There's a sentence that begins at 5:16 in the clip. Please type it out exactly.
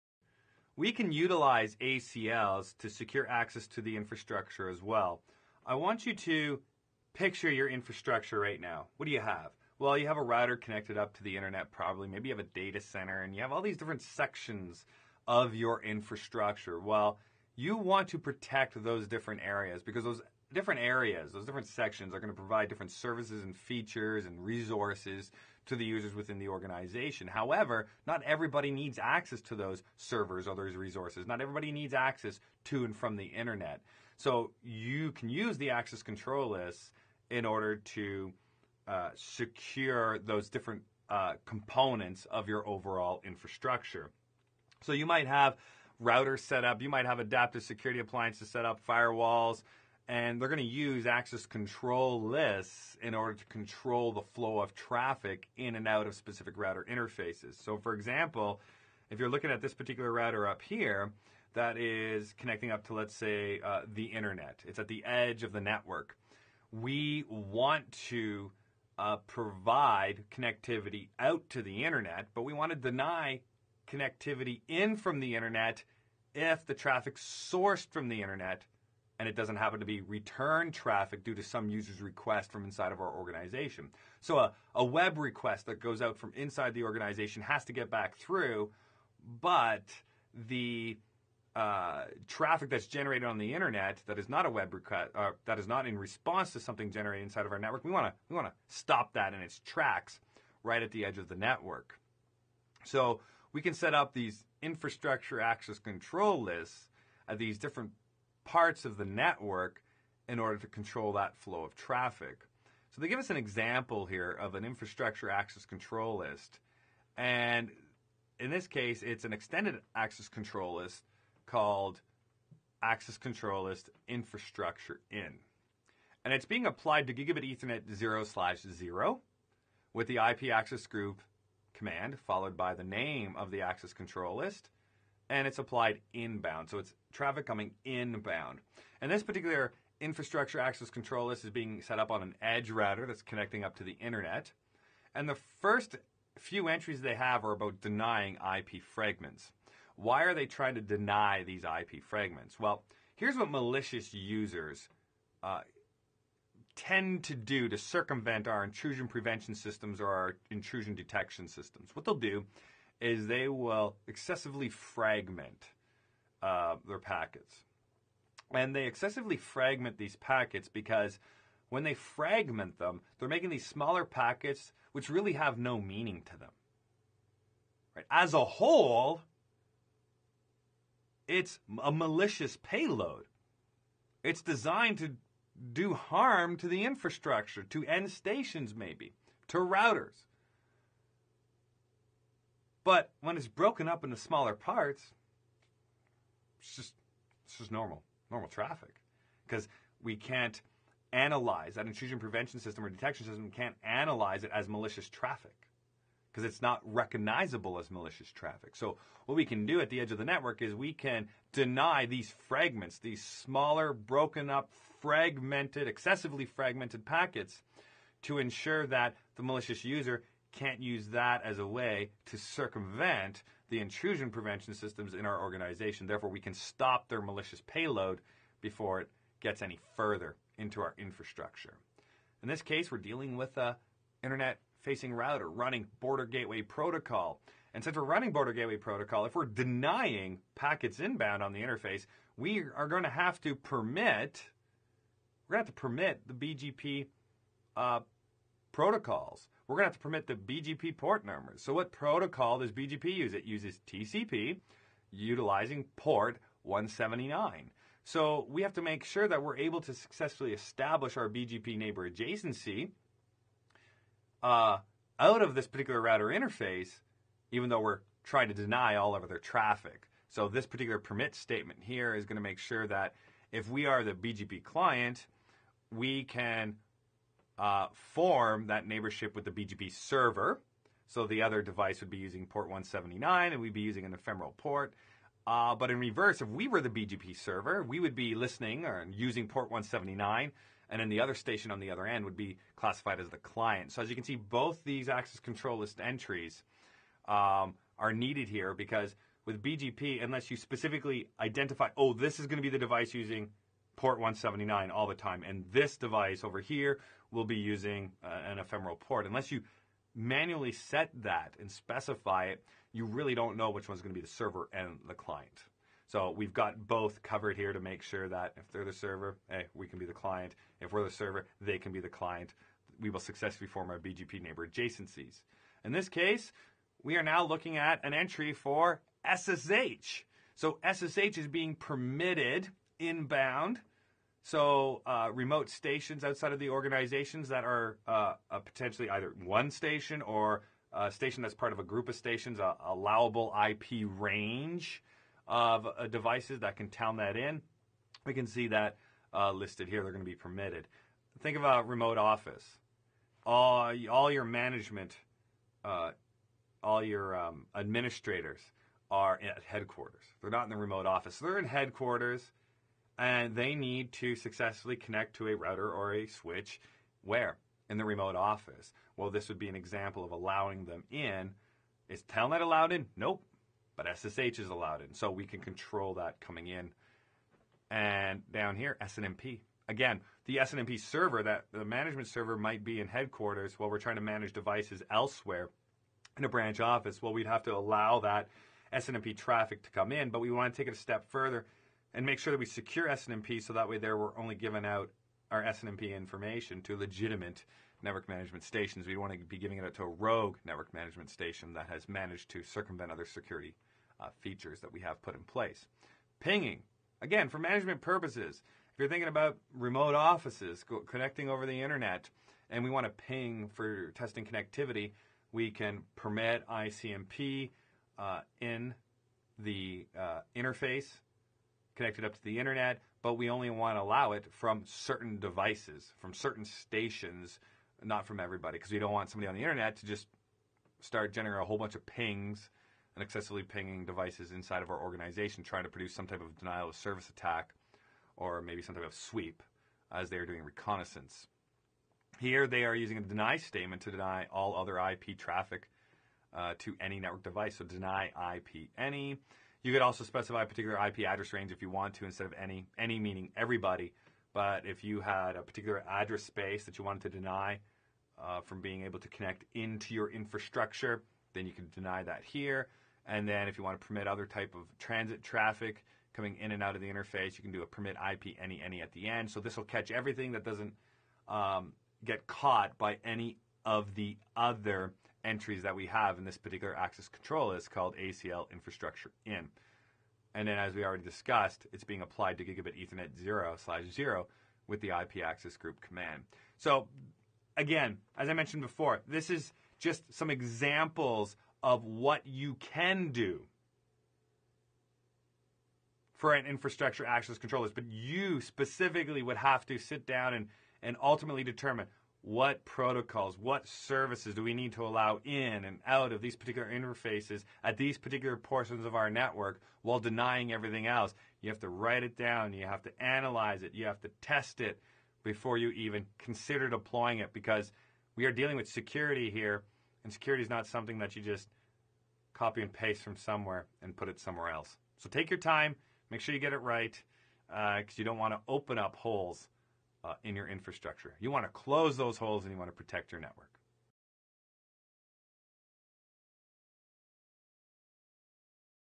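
So we've got both covered here to make sure that if they're the server, hey, we can be the client.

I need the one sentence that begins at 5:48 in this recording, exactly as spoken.
We can see that uh, listed here.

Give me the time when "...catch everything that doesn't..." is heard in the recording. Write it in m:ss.
7:49.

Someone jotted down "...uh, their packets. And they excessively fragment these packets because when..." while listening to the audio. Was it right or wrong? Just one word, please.
right.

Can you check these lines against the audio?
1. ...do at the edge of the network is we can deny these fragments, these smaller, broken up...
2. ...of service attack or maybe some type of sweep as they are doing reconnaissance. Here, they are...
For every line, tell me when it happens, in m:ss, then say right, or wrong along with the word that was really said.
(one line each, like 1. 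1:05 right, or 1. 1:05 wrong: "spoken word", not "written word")
1. 3:29 right
2. 7:16 right.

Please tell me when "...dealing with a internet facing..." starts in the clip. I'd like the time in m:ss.
3:52.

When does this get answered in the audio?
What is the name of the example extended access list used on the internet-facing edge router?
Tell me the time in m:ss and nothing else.
2:02.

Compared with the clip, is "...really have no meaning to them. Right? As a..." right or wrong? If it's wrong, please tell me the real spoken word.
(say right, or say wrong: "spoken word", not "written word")
right.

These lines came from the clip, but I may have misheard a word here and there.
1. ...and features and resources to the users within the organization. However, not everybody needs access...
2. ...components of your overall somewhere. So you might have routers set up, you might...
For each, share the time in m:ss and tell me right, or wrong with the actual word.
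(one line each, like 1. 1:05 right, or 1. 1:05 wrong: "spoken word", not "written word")
1. 0:23 right
2. 0:41 wrong: "infrastructure", not "somewhere".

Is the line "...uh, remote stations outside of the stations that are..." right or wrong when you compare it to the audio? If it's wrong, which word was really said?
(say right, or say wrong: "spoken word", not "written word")
wrong: "organizations", not "stations".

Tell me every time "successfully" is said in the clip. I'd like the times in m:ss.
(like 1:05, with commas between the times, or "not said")
4:19, 5:23, 6:04.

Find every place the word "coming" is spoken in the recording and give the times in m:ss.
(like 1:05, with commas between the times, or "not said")
2:17, 6:16, 7:46.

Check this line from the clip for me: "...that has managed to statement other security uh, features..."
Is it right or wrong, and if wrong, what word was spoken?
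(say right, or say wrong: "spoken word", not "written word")
wrong: "circumvent", not "statement".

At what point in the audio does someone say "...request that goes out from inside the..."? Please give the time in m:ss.
1:25.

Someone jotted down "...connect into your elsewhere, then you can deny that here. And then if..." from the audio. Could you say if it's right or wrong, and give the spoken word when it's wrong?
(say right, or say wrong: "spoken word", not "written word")
wrong: "infrastructure", not "elsewhere".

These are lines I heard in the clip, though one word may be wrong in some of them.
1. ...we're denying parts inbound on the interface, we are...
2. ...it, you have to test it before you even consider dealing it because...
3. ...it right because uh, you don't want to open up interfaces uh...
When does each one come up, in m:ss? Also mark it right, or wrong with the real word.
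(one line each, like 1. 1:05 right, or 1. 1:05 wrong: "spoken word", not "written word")
1. 3:59 wrong: "packets", not "parts"
2. 8:33 wrong: "deploying", not "dealing"
3. 8:46 wrong: "holes", not "interfaces".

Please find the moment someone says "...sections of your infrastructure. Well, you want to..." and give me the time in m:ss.
0:14.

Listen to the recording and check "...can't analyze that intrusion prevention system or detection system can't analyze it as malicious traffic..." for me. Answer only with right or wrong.
right.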